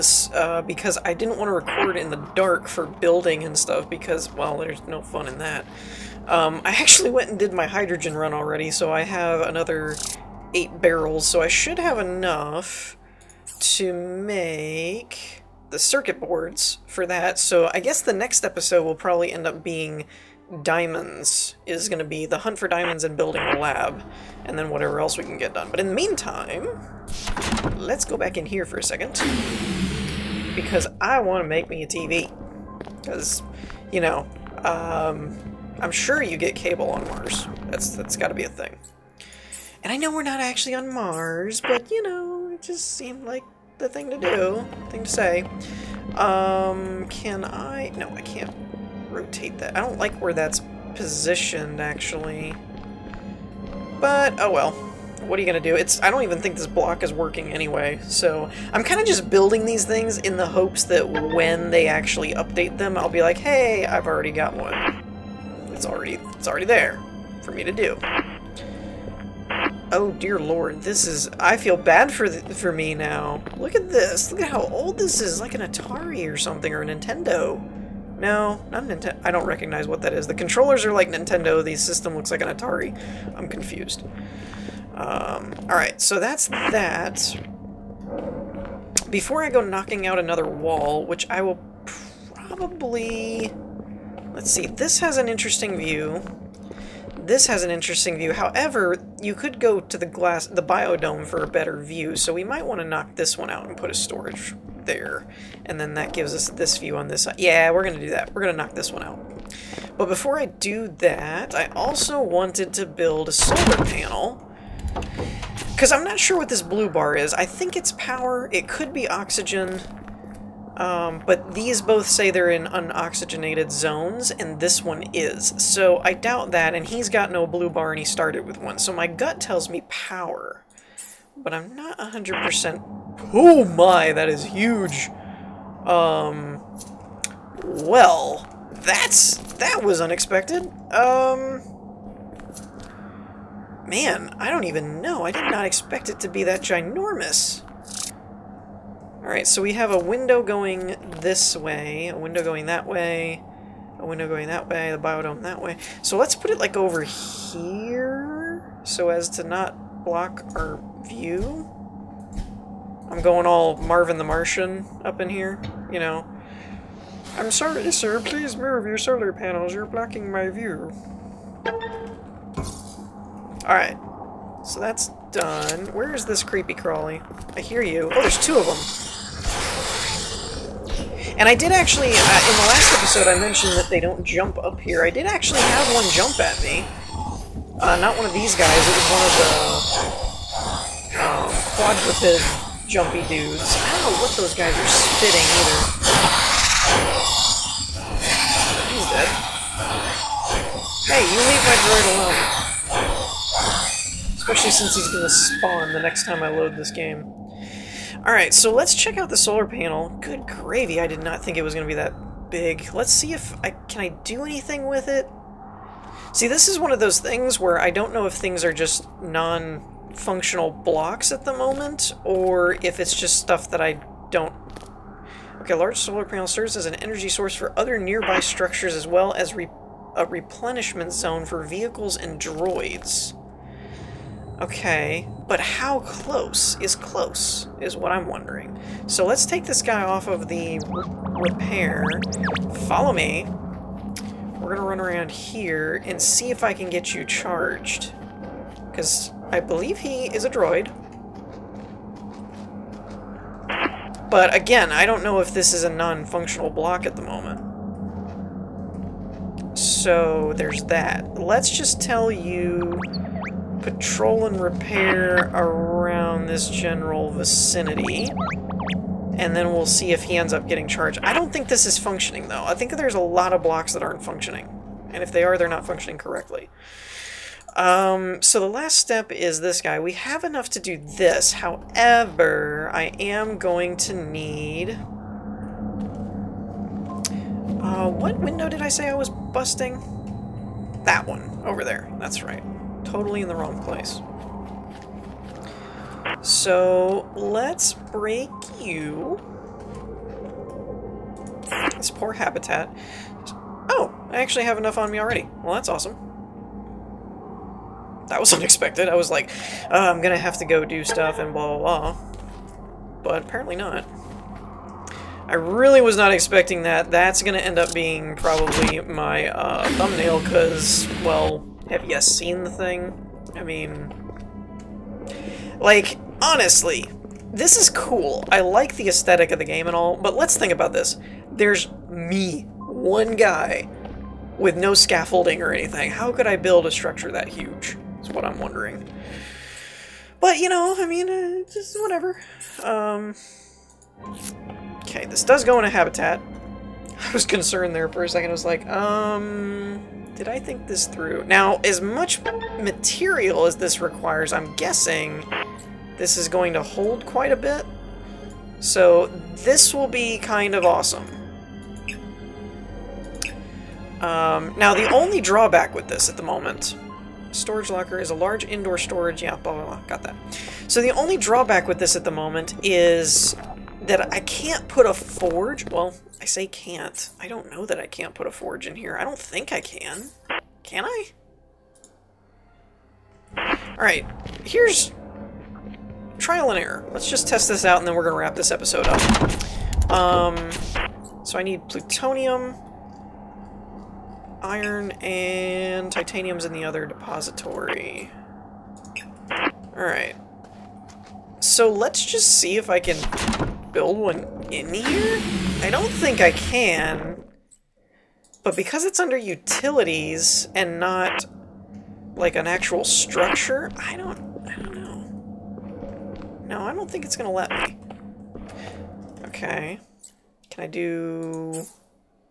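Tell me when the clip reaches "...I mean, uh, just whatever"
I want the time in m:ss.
5:40.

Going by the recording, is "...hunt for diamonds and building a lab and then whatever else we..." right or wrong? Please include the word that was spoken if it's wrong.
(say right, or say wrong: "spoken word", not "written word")
right.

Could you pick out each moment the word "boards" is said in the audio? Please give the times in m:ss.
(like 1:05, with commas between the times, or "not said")
0:16.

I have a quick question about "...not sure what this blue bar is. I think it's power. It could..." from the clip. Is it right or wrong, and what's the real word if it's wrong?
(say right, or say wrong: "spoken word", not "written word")
right.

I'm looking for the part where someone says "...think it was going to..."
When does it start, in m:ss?
3:31.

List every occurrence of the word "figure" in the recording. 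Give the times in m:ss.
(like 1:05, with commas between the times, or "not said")
not said.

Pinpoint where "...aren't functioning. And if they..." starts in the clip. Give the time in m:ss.
4:34.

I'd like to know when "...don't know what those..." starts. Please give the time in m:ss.
3:13.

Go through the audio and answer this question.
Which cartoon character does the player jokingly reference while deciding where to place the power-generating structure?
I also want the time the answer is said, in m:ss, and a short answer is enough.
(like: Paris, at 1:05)
Marvin the Martian, at 2:43.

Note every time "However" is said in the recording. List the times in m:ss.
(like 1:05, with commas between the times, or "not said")
1:38, 4:41.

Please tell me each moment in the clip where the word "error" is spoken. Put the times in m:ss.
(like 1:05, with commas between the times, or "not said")
6:26.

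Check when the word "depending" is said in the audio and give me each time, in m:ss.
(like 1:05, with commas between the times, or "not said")
not said.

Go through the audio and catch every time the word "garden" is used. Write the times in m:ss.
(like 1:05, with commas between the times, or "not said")
not said.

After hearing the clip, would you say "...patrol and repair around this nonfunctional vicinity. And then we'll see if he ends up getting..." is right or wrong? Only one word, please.
wrong.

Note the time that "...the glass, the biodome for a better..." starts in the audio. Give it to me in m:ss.
1:39.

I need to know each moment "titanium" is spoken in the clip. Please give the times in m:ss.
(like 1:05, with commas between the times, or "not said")
6:36.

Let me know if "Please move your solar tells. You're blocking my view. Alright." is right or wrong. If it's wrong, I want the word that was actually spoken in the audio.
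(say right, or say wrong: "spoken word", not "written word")
wrong: "panels", not "tells".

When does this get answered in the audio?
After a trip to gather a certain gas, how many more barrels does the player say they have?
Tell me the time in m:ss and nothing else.
0:10.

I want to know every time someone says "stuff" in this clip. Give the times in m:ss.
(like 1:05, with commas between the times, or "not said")
0:03, 3:43, 5:11.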